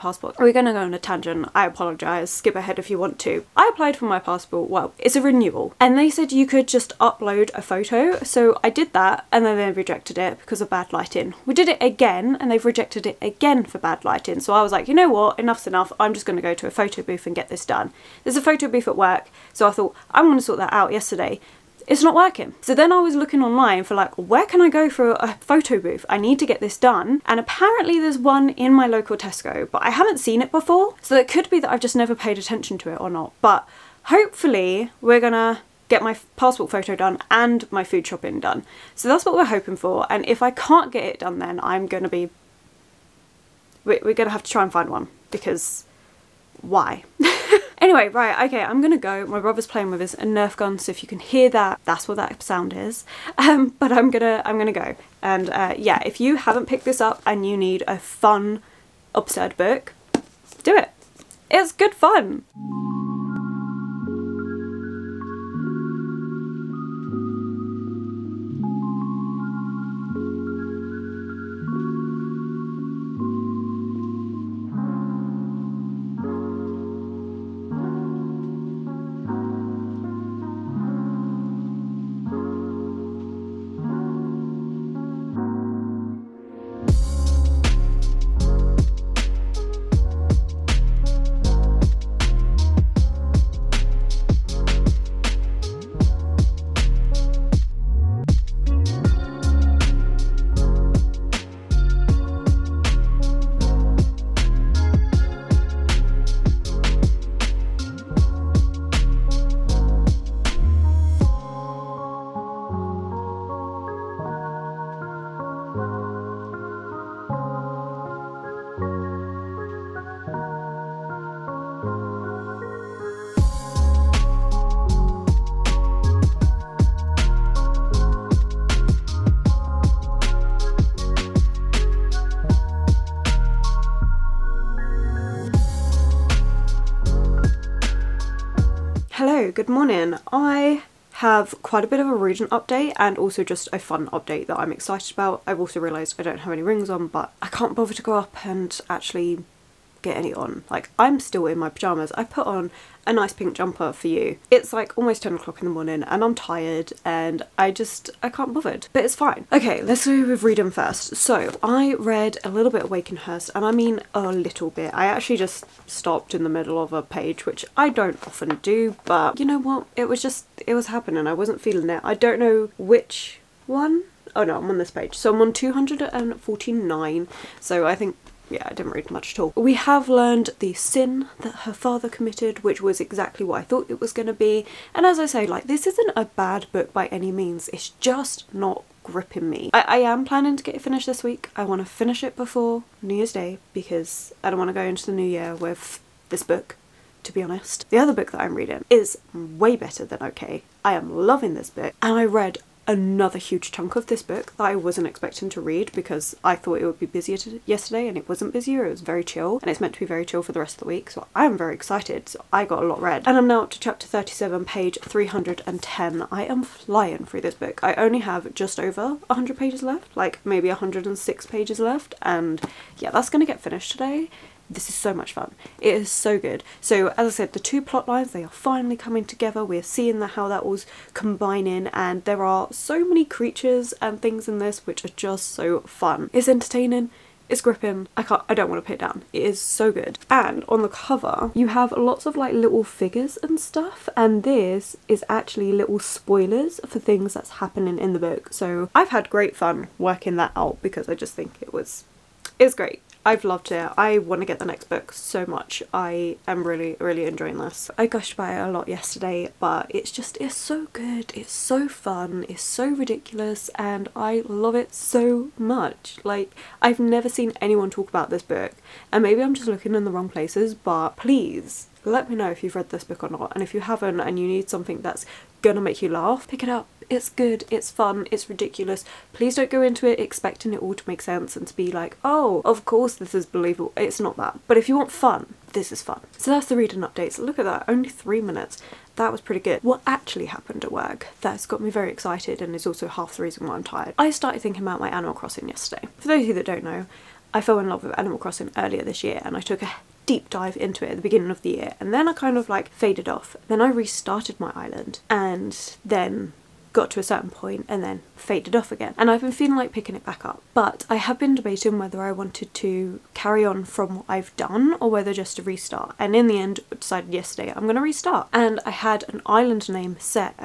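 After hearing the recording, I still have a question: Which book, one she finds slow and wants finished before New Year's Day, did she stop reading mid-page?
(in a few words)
Wakenhurst.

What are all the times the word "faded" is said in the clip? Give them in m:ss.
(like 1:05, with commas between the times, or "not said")
5:02, 5:08.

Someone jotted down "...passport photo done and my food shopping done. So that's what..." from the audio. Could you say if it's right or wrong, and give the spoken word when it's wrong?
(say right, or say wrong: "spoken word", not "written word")
right.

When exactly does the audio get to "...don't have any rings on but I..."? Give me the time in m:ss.
2:26.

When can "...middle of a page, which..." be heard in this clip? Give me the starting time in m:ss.
2:46.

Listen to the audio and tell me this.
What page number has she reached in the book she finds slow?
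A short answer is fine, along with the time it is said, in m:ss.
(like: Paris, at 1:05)
249, at 2:55.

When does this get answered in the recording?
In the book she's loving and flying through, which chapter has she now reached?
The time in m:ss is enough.
3:33.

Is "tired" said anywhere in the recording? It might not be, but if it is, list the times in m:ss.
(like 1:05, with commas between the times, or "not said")
2:36, 4:53.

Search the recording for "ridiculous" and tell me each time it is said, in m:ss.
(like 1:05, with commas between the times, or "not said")
4:22, 4:38.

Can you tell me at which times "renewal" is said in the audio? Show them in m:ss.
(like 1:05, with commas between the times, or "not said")
0:05.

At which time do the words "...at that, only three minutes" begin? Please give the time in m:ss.
4:47.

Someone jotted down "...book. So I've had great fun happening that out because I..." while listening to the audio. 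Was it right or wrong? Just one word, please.
wrong.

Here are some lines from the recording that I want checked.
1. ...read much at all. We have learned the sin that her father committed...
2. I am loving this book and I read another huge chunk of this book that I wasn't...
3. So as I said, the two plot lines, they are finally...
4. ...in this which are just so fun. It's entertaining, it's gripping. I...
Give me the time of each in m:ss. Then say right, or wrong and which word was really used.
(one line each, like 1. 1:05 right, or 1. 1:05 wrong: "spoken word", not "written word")
1. 2:58 right
2. 3:20 right
3. 3:46 right
4. 3:54 right.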